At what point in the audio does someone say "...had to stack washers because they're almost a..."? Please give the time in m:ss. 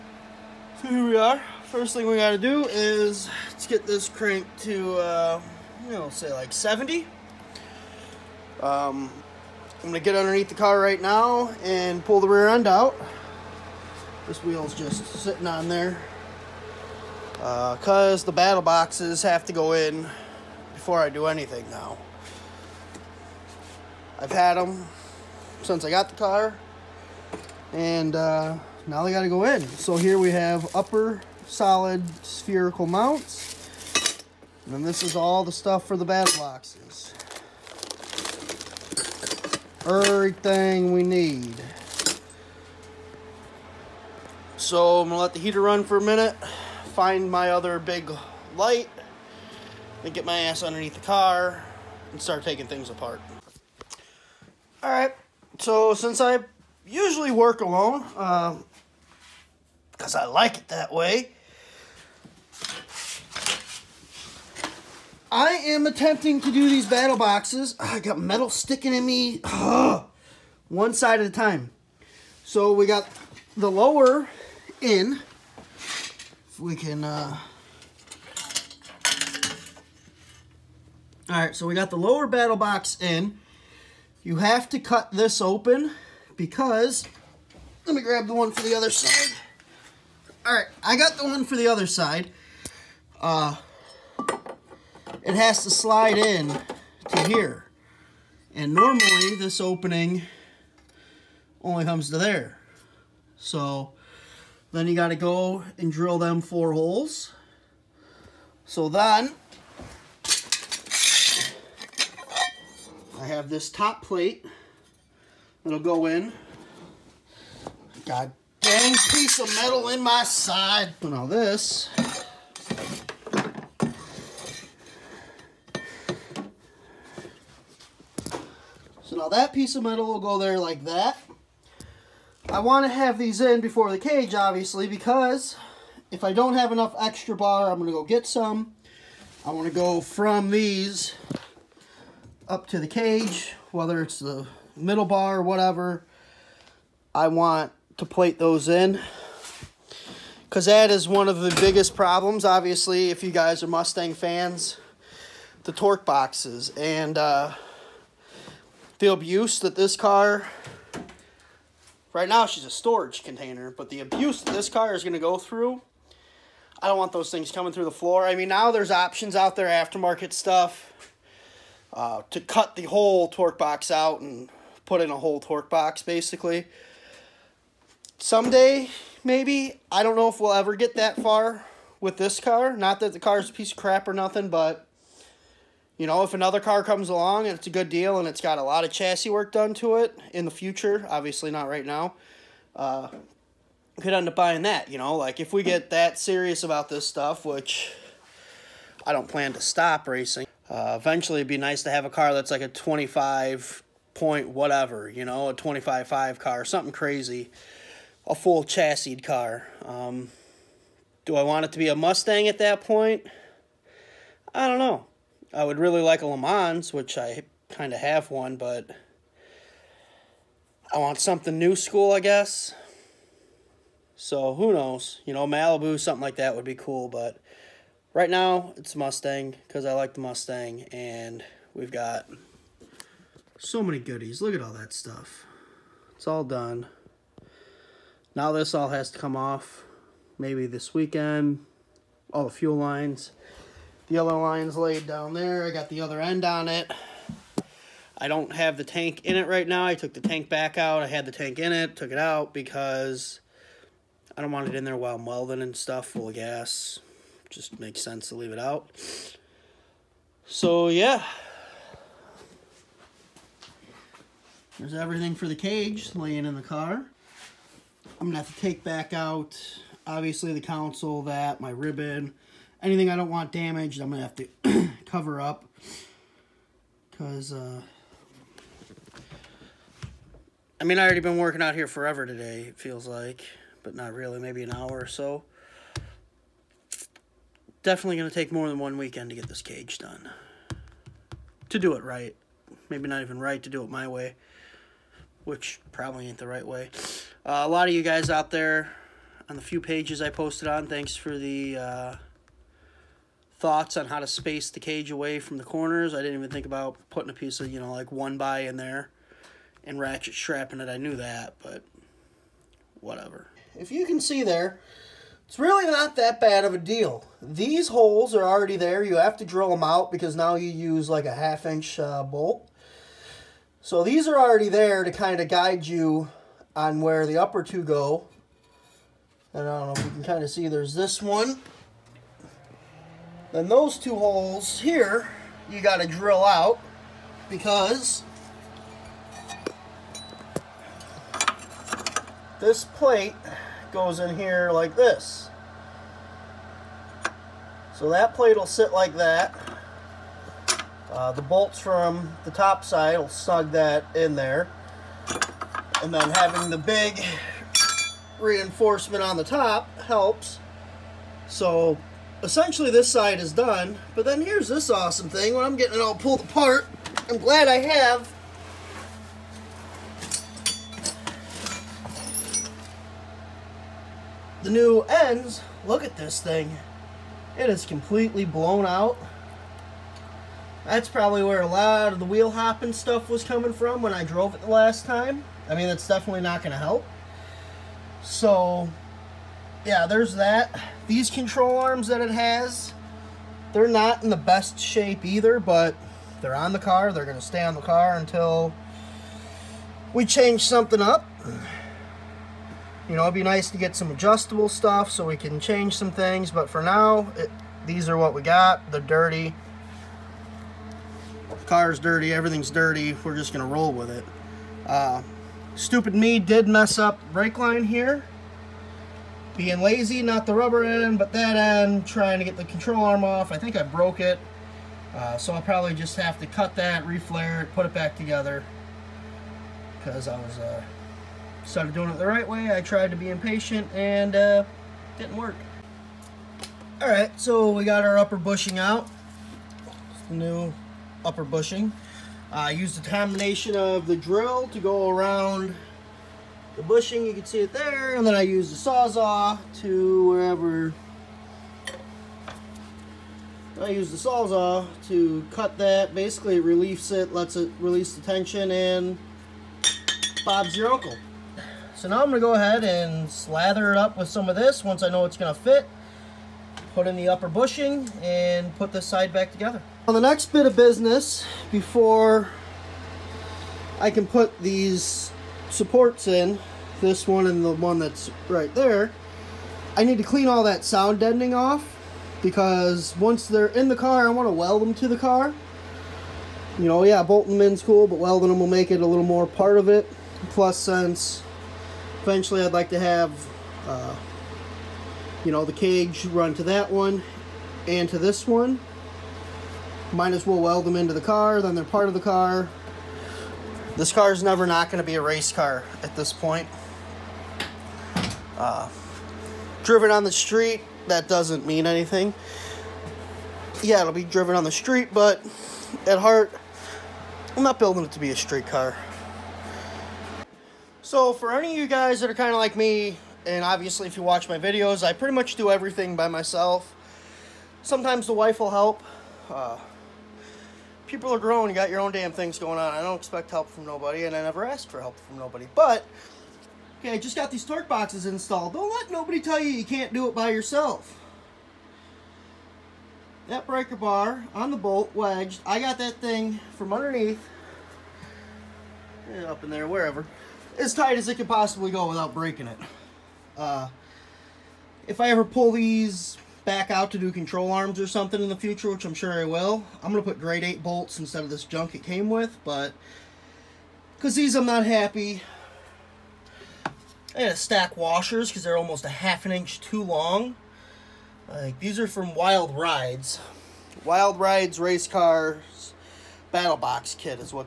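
9:27.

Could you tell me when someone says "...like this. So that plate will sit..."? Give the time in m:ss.
5:44.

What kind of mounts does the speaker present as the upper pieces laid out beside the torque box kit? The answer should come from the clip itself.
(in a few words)
solid spherical mounts.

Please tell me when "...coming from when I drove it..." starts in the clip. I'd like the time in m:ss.
6:23.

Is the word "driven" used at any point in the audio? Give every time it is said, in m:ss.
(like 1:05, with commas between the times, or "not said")
8:29, 8:34.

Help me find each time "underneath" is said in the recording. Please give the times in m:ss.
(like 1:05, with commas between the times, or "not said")
0:10, 0:50, 9:06.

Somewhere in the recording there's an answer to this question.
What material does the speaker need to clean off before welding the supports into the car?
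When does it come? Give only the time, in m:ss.
8:00.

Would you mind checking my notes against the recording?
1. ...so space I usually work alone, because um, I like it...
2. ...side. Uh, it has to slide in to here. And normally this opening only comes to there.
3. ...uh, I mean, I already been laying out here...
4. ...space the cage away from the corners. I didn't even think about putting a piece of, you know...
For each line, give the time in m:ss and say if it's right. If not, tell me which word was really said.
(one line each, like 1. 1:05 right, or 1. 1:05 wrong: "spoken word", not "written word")
1. 0:55 wrong: "since", not "space"
2. 1:31 right
3. 4:37 wrong: "working", not "laying"
4. 5:04 right.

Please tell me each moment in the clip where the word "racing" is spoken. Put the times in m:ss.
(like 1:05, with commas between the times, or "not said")
3:20.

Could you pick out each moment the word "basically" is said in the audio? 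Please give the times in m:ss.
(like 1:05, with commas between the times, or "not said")
2:56, 7:36.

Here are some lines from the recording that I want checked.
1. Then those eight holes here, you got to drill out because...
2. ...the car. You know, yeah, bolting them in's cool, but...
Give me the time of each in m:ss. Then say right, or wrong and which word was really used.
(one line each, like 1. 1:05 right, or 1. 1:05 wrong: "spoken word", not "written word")
1. 5:33 wrong: "two", not "eight"
2. 8:05 right.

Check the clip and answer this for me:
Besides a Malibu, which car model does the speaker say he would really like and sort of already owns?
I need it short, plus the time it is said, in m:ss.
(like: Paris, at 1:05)
Le Mans, at 3:36.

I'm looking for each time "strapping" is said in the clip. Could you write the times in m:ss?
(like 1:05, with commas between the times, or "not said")
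5:10.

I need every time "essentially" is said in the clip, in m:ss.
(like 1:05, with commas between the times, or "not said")
6:02.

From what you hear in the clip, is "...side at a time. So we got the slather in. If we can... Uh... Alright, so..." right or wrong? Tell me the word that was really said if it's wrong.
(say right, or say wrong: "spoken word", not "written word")
wrong: "lower", not "slather".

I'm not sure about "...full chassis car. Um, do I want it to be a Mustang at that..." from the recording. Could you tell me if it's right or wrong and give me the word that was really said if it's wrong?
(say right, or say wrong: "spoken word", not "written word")
right.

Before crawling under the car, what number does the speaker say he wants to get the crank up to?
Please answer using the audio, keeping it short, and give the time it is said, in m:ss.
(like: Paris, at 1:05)
70, at 0:06.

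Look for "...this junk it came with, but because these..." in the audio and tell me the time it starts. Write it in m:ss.
9:21.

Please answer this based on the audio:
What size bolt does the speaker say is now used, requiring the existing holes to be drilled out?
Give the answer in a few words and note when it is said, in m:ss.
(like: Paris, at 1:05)
half inch, at 5:21.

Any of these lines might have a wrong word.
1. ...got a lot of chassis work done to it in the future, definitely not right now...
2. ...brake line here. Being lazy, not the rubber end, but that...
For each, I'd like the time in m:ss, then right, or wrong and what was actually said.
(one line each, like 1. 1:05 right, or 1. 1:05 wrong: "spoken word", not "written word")
1. 3:08 wrong: "obviously", not "definitely"
2. 6:57 right.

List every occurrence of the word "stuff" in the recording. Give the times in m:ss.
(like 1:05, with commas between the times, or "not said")
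0:35, 2:50, 3:17, 3:54, 4:15, 6:22, 6:44.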